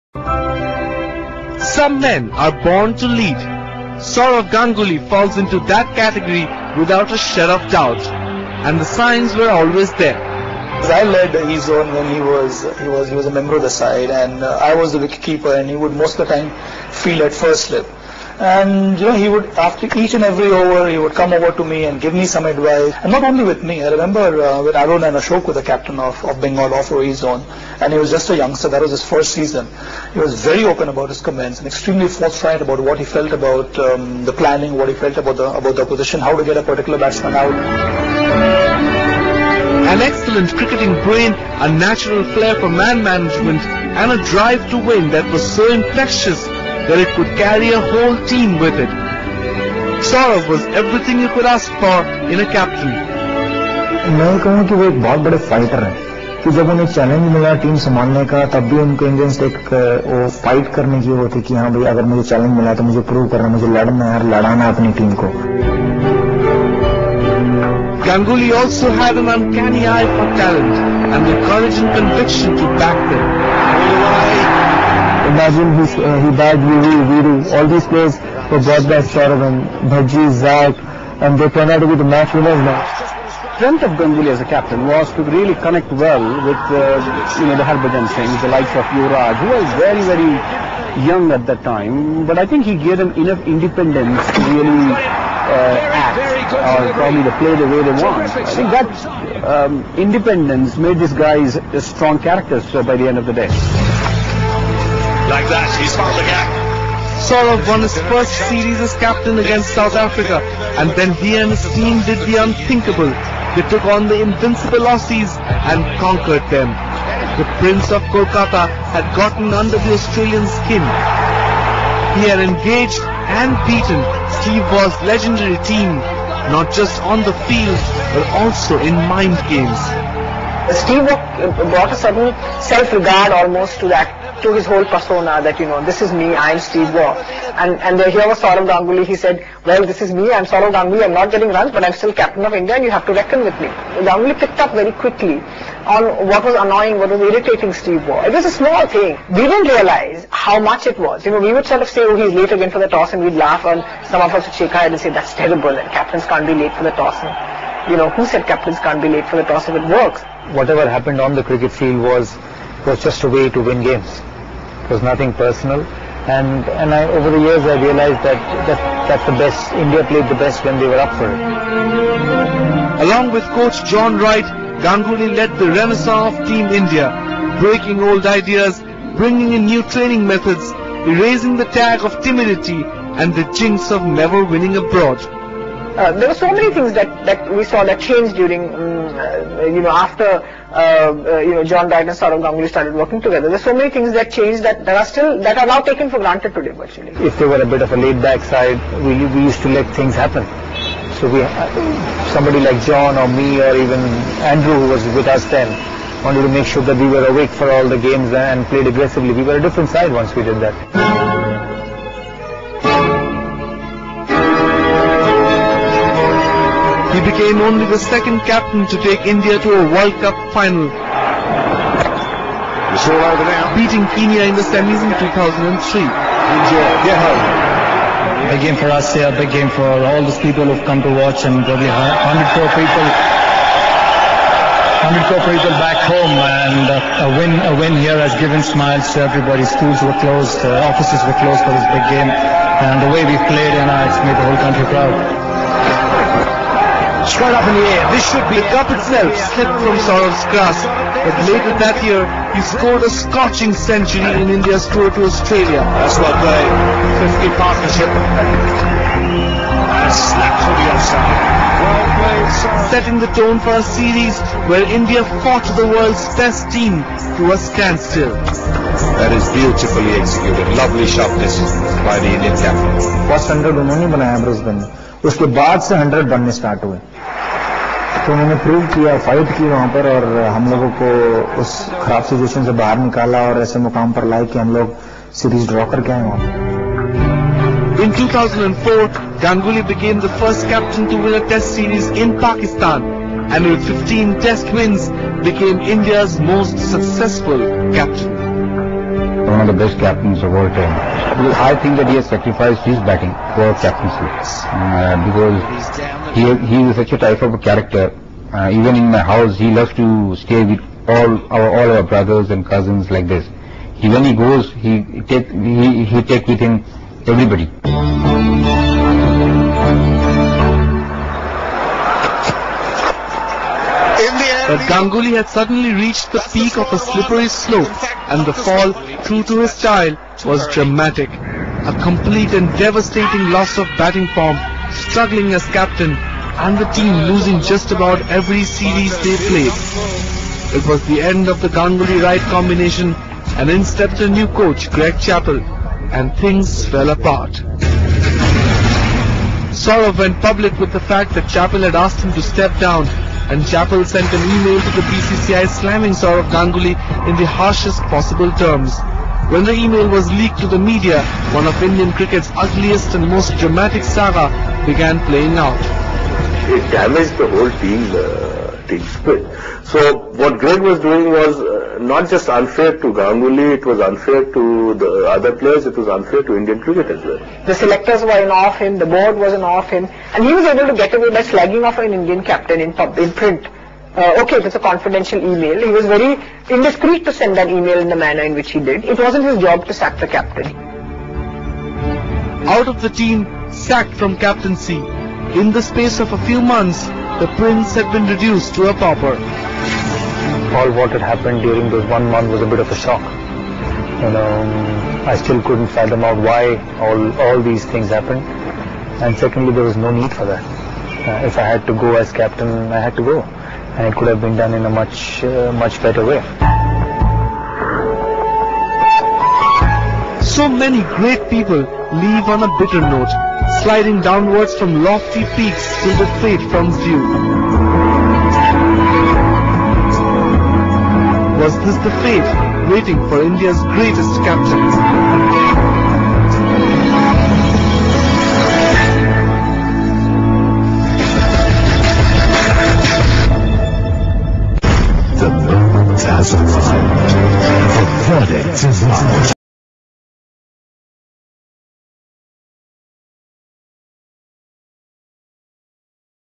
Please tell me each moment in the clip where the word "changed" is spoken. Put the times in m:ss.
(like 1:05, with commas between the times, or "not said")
3:07, 3:14.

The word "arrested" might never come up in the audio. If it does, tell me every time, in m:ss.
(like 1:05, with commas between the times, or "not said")
not said.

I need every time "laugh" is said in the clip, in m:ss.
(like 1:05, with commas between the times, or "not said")
2:33.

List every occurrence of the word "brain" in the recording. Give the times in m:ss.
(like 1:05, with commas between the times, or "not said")
0:41.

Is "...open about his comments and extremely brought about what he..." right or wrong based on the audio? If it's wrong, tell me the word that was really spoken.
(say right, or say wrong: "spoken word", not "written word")
wrong: "forthright", not "brought".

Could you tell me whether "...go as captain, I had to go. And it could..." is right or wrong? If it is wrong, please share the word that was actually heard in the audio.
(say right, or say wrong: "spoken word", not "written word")
right.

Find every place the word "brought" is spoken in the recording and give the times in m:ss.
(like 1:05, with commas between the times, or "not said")
1:18, 2:11.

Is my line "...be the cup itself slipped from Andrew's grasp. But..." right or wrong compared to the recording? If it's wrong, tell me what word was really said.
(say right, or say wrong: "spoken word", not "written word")
wrong: "Sourav", not "Andrew".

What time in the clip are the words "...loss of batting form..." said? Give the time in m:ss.
5:33.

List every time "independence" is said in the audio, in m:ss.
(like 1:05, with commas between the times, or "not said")
1:33, 1:39.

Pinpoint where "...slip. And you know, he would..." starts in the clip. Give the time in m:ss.
0:17.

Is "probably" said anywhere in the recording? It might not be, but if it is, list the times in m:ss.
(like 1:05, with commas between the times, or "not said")
1:36, 3:51.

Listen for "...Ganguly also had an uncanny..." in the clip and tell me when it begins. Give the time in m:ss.
1:08.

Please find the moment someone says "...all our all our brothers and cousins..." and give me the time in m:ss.
5:11.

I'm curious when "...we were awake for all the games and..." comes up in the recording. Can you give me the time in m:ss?
3:26.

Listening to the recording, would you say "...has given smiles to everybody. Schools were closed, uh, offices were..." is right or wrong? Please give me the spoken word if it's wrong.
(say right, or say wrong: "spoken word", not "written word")
right.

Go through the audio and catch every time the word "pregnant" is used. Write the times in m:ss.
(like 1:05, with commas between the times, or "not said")
not said.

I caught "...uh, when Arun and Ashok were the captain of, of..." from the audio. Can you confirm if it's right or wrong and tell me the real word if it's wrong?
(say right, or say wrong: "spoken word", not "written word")
right.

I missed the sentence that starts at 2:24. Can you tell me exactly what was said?
Ganguly picked up very quickly on what was annoying, what was irritating Steve Waugh.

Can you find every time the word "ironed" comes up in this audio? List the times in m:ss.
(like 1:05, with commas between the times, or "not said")
not said.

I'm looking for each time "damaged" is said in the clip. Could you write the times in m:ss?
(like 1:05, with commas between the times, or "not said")
6:06.